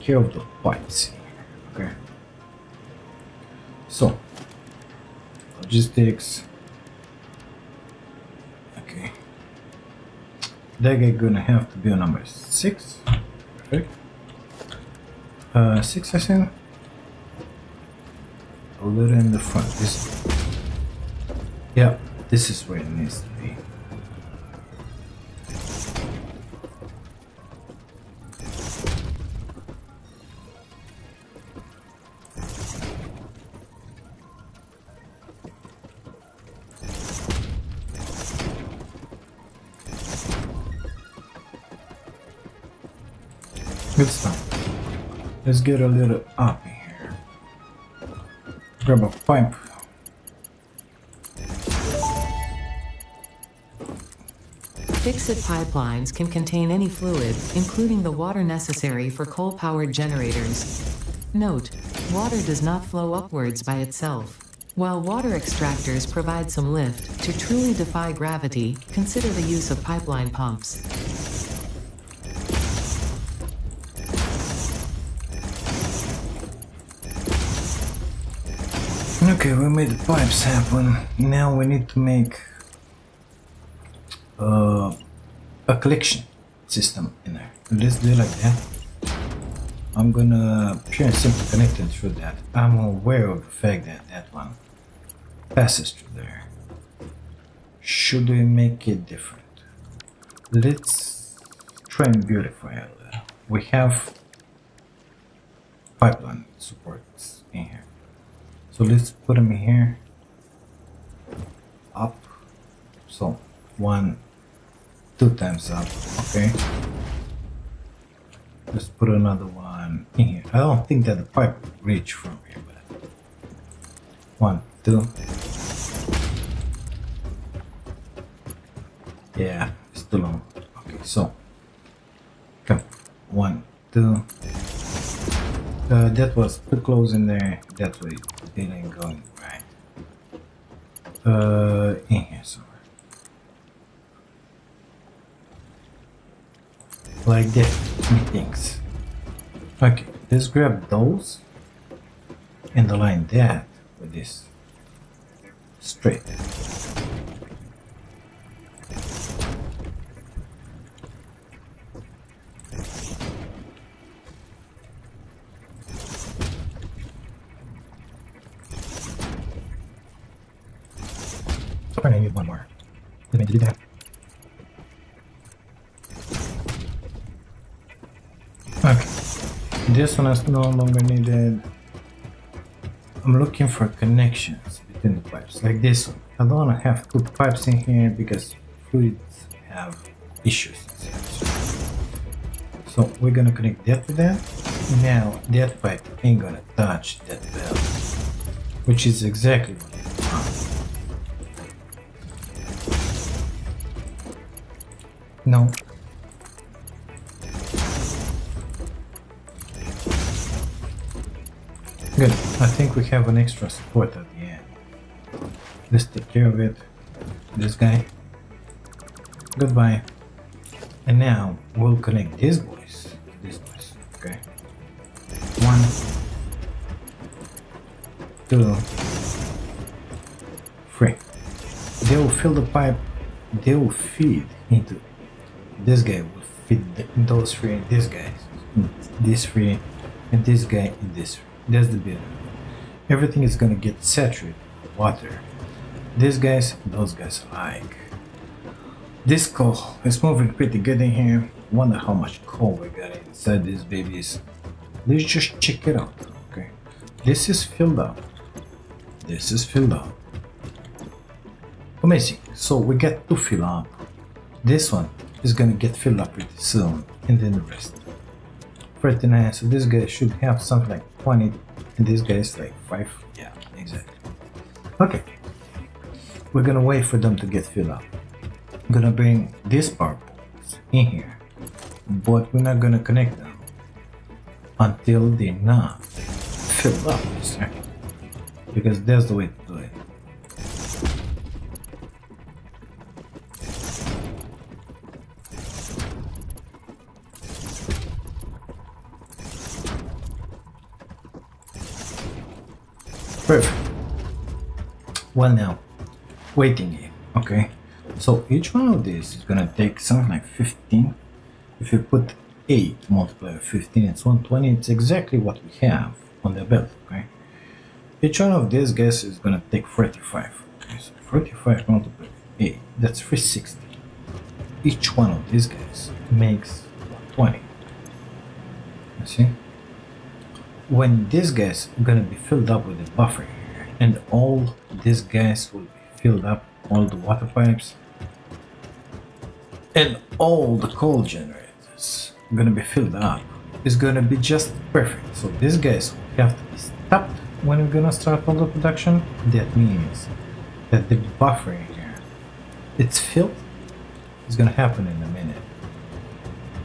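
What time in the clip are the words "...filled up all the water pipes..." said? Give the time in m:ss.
5:36.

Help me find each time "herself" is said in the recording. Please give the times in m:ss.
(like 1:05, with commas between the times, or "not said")
not said.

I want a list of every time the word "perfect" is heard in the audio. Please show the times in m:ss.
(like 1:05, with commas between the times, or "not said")
0:13, 5:03, 5:44.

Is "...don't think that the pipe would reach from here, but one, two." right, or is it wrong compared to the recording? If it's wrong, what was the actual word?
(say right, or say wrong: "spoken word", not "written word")
right.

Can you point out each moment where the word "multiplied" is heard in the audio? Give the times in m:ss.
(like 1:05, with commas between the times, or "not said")
5:13, 5:21.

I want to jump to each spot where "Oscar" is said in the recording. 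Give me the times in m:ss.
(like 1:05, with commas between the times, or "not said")
not said.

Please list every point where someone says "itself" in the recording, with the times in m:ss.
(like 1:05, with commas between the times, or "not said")
1:03.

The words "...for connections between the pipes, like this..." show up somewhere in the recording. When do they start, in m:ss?
3:03.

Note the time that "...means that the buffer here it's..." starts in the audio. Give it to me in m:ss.
5:49.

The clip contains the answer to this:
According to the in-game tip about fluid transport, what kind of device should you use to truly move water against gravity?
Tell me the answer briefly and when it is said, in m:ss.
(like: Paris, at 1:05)
pipeline pumps, at 1:09.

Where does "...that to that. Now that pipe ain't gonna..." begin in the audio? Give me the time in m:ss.
3:13.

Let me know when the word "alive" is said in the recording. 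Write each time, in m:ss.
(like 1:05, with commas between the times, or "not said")
not said.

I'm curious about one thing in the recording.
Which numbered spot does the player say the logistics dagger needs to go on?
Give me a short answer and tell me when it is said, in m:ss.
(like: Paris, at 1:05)
6, at 0:11.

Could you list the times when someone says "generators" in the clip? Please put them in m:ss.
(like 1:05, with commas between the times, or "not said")
0:59, 5:41.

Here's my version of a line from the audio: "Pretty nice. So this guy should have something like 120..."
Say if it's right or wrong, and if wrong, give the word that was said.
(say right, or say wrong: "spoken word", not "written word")
wrong: "180", not "120".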